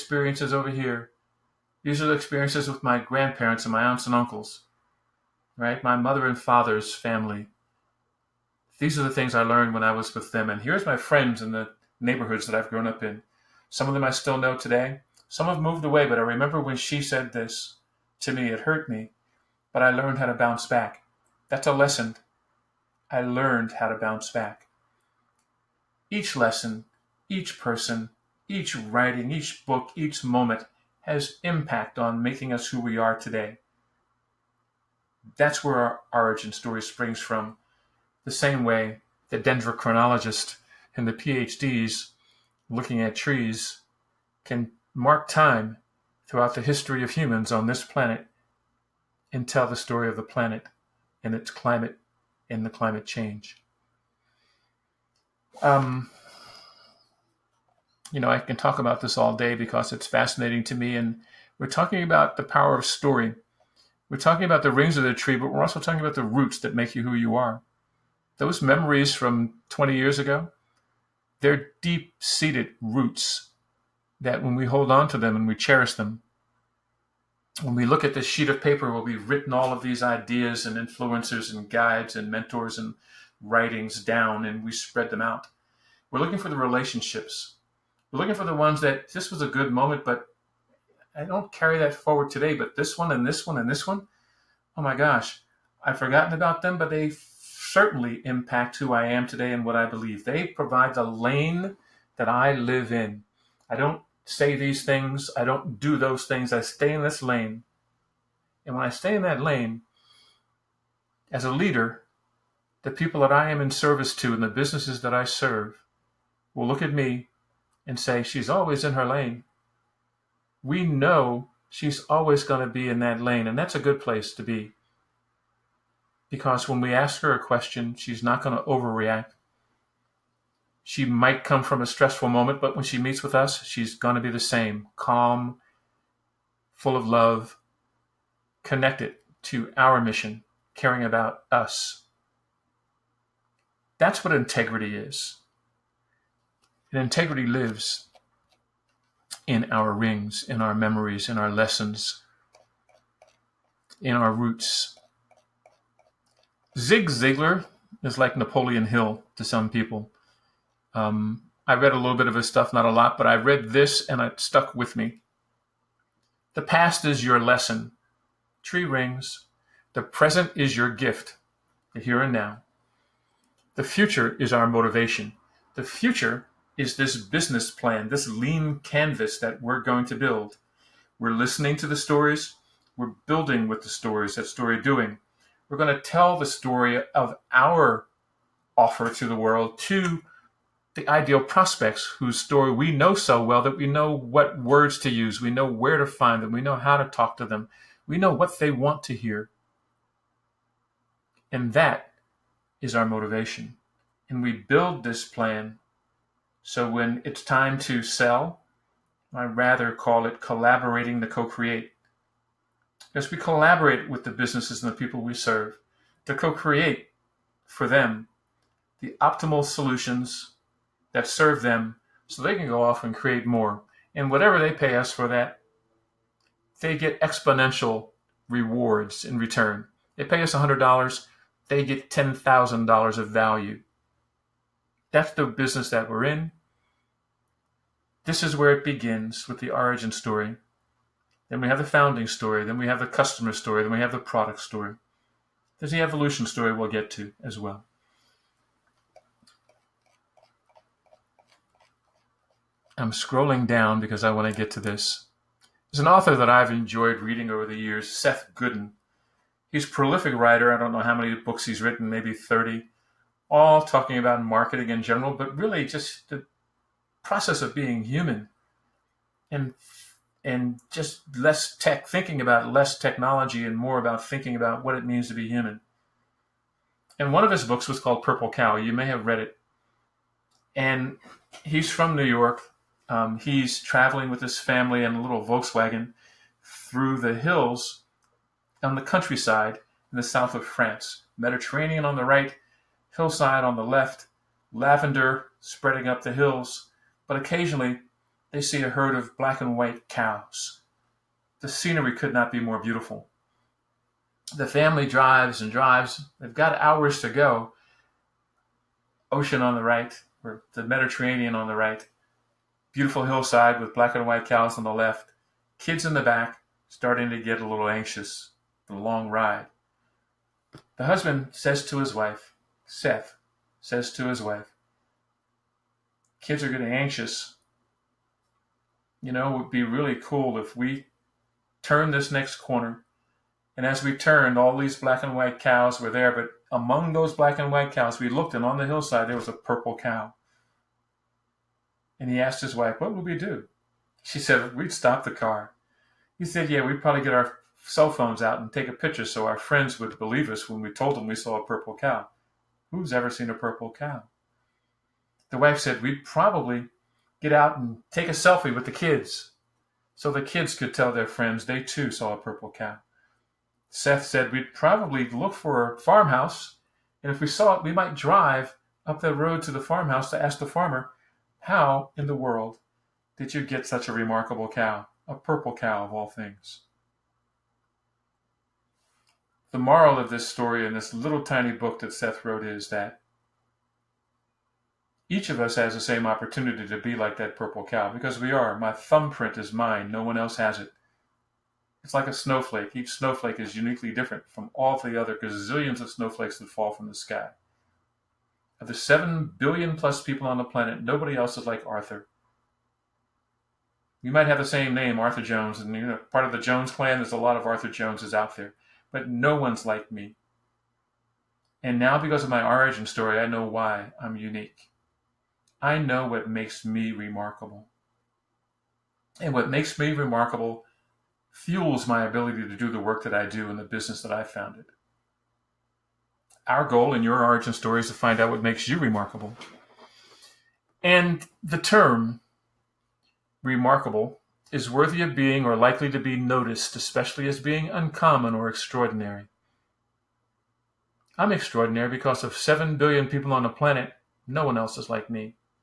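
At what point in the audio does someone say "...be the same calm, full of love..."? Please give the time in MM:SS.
02:14.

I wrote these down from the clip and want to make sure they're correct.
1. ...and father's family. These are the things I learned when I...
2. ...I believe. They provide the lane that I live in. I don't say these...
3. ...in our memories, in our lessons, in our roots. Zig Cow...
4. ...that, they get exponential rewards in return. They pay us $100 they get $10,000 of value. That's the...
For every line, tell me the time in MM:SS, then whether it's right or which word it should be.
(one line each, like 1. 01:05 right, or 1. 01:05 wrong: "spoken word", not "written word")
1. 00:06 right
2. 01:39 right
3. 02:30 wrong: "Ziglar", not "Cow"
4. 03:45 right.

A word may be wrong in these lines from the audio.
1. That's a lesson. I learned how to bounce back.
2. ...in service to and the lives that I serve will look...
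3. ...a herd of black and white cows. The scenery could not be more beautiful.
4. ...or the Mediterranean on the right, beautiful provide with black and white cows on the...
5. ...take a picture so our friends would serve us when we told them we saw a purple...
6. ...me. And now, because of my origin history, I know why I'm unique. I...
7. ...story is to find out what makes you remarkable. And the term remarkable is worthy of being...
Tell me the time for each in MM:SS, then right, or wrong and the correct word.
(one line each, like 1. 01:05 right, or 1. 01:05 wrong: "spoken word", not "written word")
1. 00:21 right
2. 01:53 wrong: "businesses", not "lives"
3. 04:58 right
4. 05:10 wrong: "hillside", not "provide"
5. 05:48 wrong: "believe", not "serve"
6. 06:50 wrong: "story", not "history"
7. 07:07 right.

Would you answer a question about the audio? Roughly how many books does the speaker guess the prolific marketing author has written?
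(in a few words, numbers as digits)
30.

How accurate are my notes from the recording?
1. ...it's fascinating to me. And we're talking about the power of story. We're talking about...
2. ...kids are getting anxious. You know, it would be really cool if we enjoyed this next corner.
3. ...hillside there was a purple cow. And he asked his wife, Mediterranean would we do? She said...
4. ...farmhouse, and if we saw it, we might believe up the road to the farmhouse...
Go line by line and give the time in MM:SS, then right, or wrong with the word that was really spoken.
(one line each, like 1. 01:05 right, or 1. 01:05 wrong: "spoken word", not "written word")
1. 00:59 right
2. 05:26 wrong: "turned", not "enjoyed"
3. 05:38 wrong: "What", not "Mediterranean"
4. 06:05 wrong: "drive", not "believe".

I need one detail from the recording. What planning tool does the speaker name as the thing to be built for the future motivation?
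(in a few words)
lean canvas.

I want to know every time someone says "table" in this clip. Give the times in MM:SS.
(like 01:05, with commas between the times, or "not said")
not said.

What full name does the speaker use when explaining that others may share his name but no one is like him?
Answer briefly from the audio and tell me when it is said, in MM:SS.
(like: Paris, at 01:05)
Arthur Jones, at 06:45.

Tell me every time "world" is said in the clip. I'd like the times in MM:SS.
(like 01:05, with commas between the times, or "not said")
03:09, 06:12.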